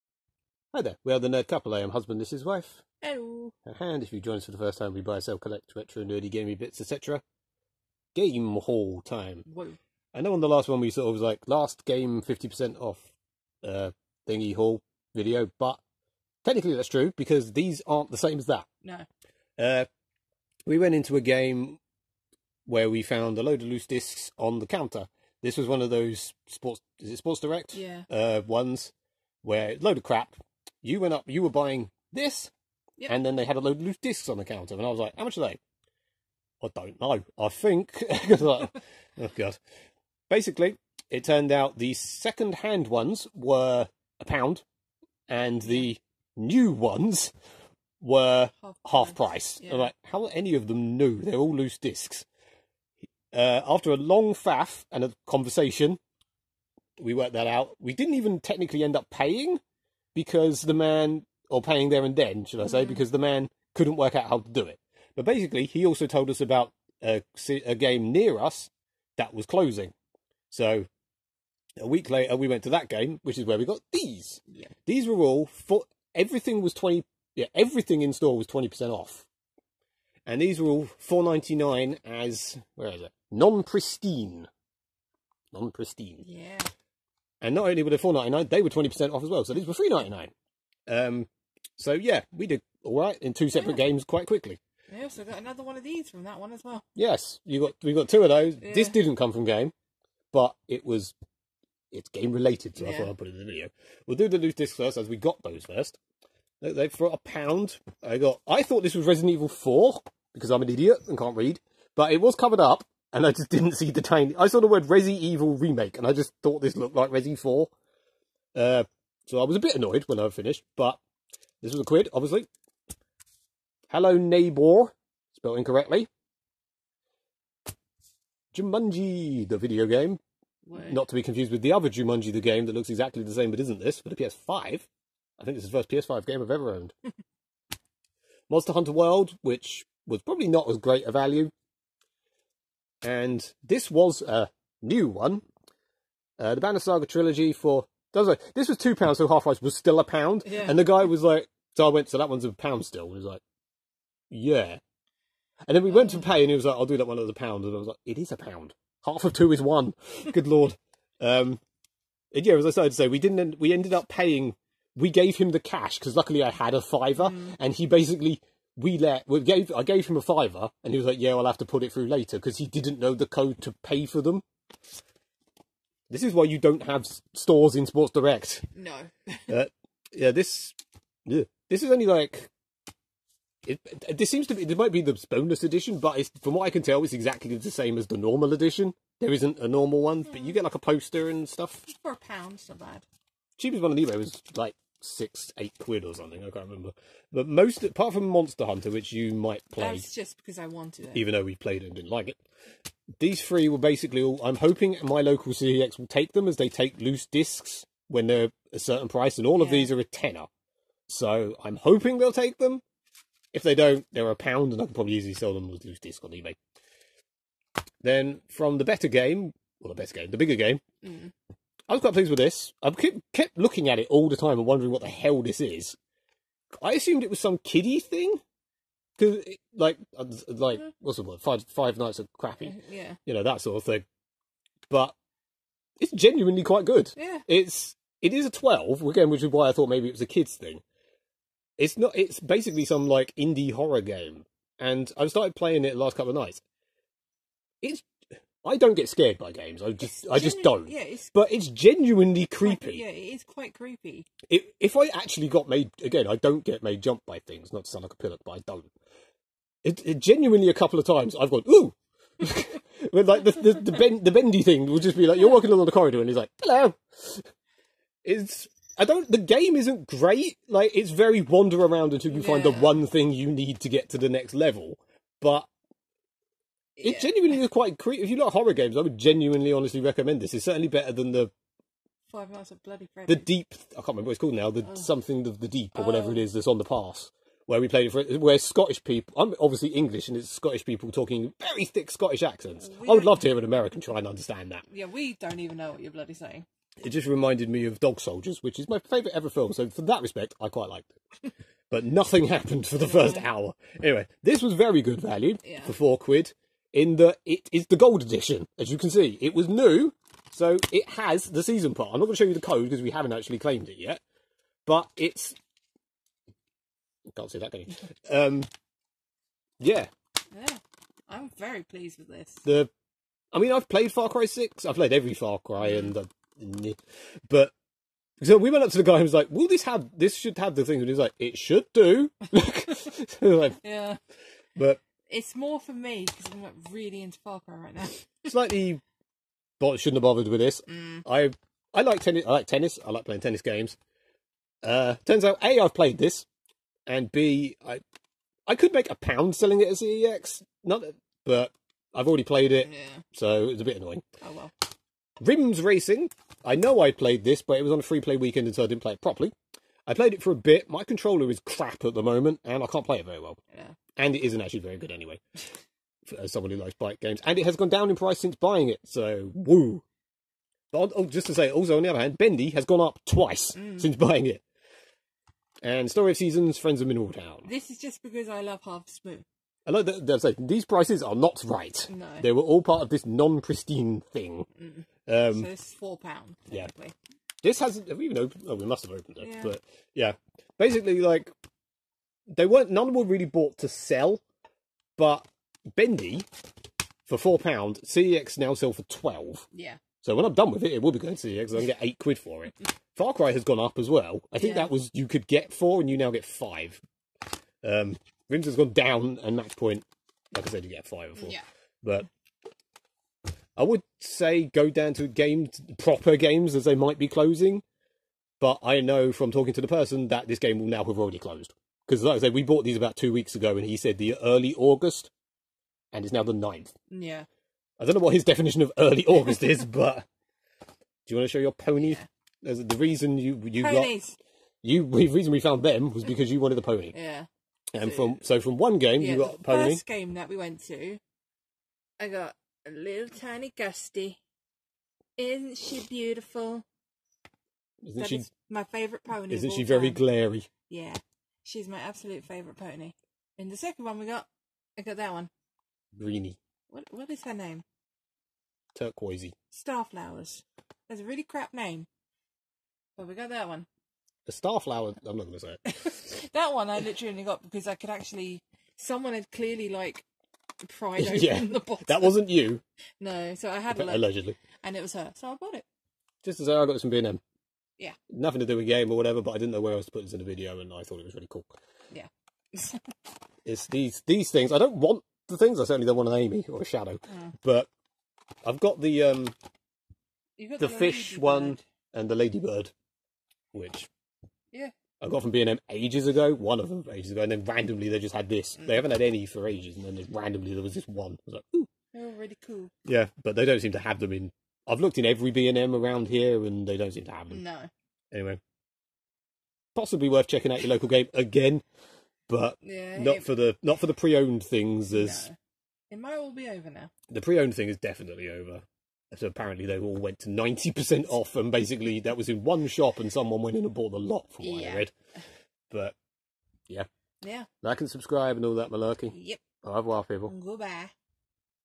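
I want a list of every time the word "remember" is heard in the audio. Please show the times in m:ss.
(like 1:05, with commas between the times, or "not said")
3:16, 4:44.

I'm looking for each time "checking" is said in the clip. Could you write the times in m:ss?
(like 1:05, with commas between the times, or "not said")
8:30.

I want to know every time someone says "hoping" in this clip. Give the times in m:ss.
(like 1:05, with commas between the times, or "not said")
3:24, 3:31.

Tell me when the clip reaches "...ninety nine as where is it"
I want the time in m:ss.
1:21.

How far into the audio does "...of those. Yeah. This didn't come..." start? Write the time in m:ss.
1:38.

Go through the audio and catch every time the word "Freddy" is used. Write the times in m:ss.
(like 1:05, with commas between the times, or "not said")
4:43.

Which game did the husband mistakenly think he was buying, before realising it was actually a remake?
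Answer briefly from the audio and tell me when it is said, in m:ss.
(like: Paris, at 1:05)
Resident Evil Four, at 1:49.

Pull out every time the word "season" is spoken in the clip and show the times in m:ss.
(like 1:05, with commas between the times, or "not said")
5:11, 6:16.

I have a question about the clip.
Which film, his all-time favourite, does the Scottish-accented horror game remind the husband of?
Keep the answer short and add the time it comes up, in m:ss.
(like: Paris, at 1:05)
Dog Soldiers, at 4:57.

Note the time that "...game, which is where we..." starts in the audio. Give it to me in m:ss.
1:12.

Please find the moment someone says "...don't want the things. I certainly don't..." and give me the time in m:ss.
8:04.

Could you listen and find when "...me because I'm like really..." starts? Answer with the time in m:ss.
5:35.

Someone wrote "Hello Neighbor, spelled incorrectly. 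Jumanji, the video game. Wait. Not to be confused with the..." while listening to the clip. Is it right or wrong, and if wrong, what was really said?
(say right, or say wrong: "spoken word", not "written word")
right.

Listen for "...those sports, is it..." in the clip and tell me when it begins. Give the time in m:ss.
0:25.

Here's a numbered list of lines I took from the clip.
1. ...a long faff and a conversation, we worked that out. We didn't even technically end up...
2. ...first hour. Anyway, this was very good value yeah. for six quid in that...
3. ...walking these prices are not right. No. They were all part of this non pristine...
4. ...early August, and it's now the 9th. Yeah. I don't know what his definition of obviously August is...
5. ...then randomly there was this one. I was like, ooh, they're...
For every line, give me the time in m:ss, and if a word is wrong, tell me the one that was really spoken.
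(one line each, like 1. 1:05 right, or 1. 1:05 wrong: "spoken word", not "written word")
1. 0:53 right
2. 5:03 wrong: "four", not "six"
3. 6:20 wrong: "saying", not "walking"
4. 7:04 wrong: "early", not "obviously"
5. 8:20 right.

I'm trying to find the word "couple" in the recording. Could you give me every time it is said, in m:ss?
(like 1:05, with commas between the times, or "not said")
0:01, 4:06, 4:20.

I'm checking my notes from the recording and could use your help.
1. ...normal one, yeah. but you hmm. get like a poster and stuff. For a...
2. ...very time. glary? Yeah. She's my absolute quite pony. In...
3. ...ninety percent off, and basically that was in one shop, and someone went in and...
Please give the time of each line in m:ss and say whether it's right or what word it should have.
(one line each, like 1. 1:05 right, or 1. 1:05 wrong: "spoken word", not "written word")
1. 3:09 right
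2. 7:29 wrong: "favourite", not "quite"
3. 8:40 right.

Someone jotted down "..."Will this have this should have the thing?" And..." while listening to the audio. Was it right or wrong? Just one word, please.
right.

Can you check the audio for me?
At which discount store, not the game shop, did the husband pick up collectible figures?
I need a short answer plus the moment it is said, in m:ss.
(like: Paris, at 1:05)
B&M, at 7:57.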